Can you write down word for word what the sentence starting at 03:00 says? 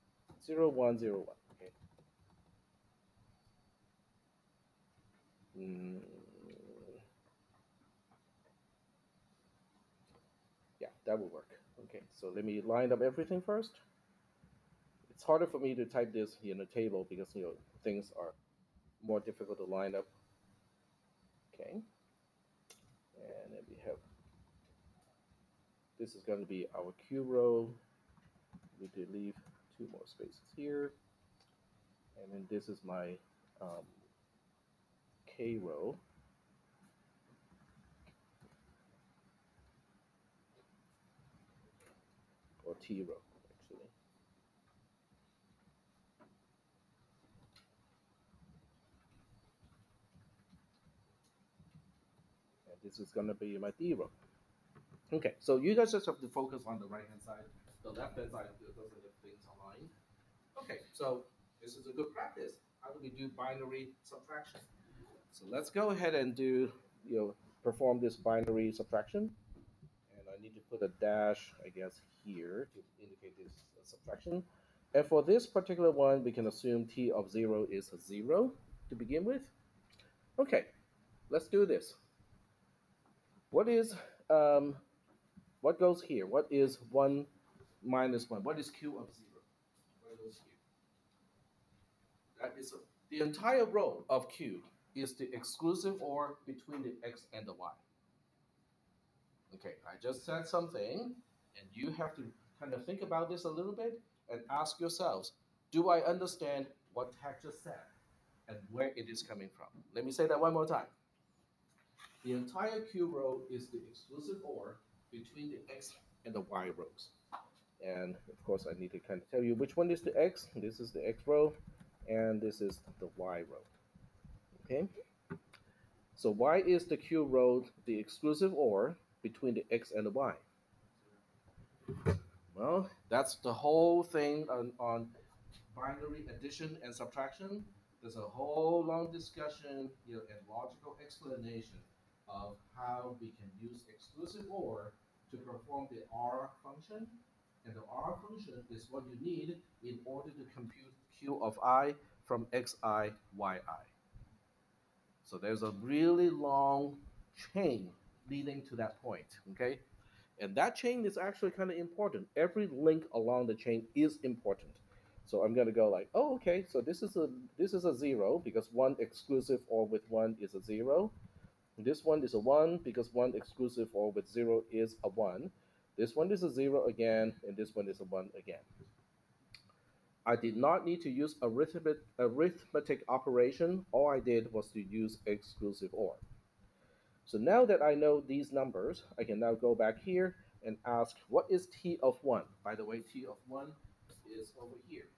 I did not need to use arithmetic, arithmetic operation.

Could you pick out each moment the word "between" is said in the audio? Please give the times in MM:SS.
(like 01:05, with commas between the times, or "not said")
01:36, 01:55, 02:09.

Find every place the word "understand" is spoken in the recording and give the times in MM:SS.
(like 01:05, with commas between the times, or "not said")
01:46.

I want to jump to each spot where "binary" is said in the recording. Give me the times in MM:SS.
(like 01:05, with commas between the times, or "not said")
01:03, 01:08, 02:15.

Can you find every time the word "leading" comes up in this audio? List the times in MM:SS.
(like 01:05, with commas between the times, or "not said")
02:38.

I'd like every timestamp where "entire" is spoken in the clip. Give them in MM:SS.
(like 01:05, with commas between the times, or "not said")
01:33, 01:52.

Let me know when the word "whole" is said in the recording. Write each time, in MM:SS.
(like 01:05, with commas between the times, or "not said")
02:13, 02:18.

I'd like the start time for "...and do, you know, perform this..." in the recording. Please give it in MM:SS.
01:06.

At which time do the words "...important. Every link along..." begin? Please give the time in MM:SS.
02:41.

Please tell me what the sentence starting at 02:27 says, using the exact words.
And the R function is what you need in order to compute Q of i from xi, yi.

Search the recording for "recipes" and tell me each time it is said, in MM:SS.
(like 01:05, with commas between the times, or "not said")
not said.